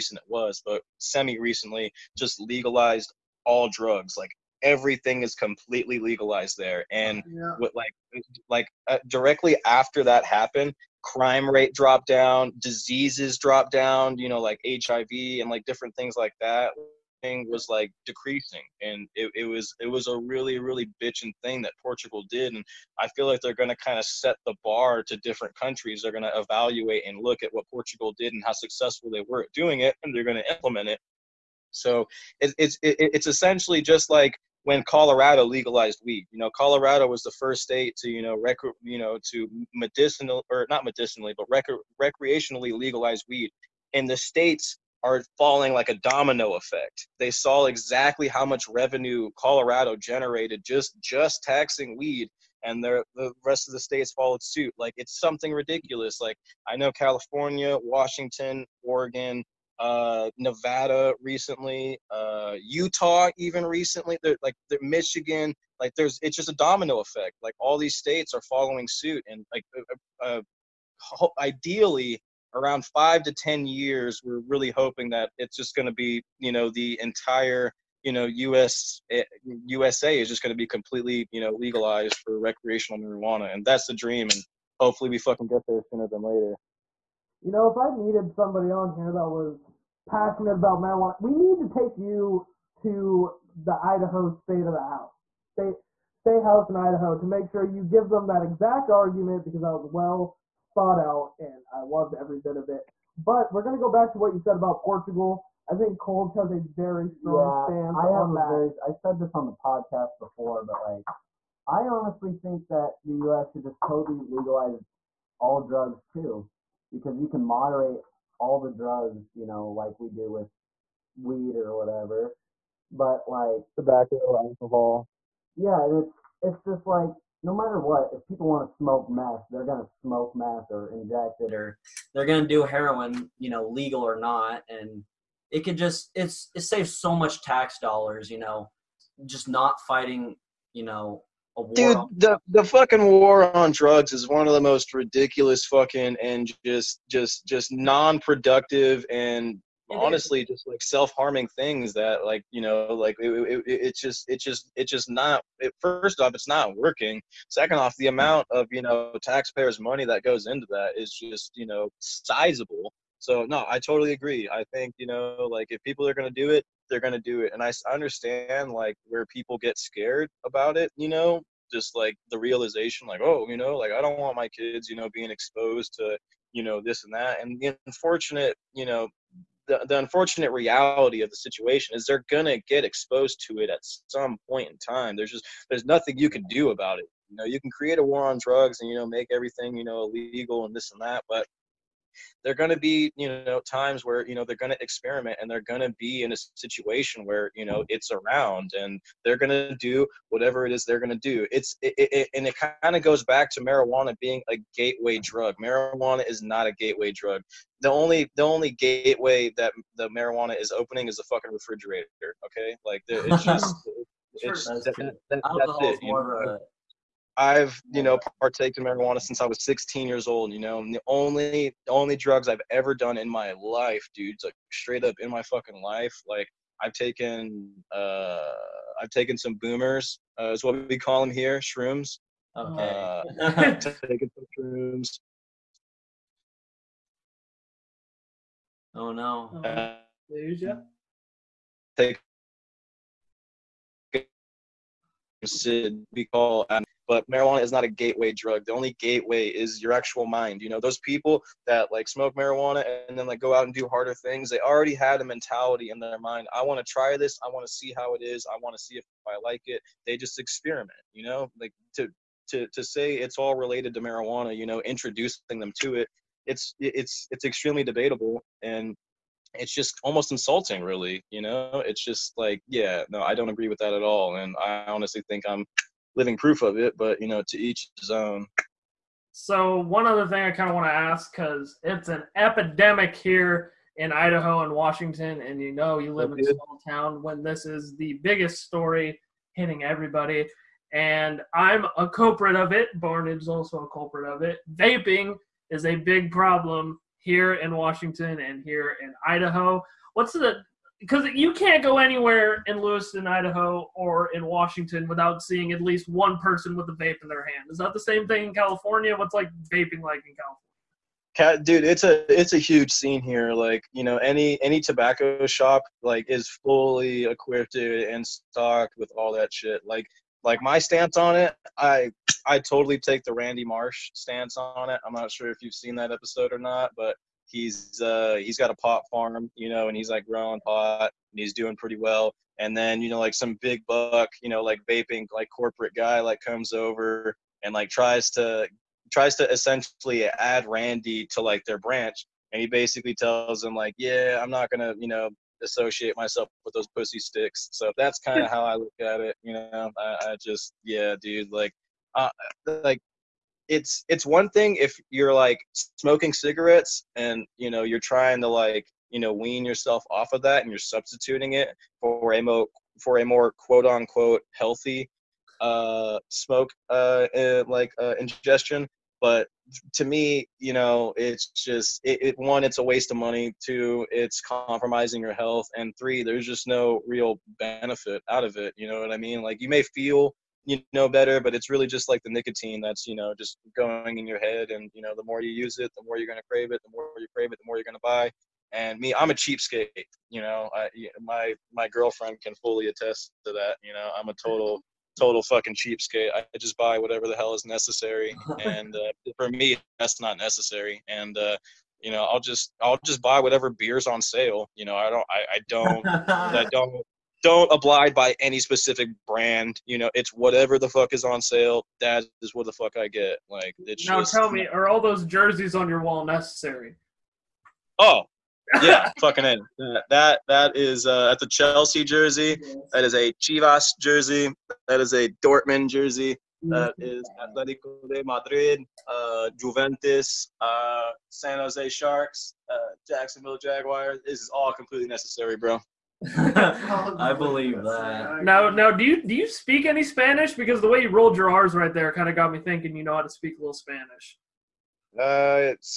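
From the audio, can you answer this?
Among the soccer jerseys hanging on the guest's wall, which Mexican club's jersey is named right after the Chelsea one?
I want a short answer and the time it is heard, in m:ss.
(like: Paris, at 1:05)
Chivas, at 7:03.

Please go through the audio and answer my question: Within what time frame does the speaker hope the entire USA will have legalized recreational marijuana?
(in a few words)
5 to 10 years.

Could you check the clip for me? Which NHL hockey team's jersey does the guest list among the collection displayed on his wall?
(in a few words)
San Jose Sharks.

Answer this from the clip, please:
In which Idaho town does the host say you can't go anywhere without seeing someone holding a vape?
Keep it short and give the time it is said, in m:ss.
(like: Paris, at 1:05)
Lewiston, at 5:02.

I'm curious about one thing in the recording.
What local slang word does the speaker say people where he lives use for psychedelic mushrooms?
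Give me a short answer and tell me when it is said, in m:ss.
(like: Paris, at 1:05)
Boomers, at 3:49.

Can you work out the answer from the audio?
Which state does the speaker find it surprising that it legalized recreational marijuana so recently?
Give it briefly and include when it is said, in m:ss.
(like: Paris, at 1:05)
Utah, at 1:02.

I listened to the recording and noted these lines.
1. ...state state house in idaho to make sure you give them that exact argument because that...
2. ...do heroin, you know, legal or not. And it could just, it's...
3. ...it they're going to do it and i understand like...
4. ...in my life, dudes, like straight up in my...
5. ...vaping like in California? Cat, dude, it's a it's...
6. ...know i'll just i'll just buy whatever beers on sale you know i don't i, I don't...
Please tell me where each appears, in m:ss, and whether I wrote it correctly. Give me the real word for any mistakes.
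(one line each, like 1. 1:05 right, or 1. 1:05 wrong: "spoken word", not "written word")
1. 1:35 right
2. 2:12 right
3. 2:46 right
4. 3:43 right
5. 5:09 right
6. 6:42 right.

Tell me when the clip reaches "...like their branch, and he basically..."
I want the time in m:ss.
5:41.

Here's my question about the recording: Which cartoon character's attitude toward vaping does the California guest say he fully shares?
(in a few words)
Randy Marsh.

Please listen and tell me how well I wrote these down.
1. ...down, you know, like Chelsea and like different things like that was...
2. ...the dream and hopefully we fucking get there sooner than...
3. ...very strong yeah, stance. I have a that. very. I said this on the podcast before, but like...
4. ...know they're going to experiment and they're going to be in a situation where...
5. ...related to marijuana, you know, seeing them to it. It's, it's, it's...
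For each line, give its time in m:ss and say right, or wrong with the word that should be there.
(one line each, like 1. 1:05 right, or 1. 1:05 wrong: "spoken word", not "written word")
1. 0:13 wrong: "HIV", not "Chelsea"
2. 1:23 right
3. 1:46 right
4. 3:14 right
5. 4:23 wrong: "introducing", not "seeing".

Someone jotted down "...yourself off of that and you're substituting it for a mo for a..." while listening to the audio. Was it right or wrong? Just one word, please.
right.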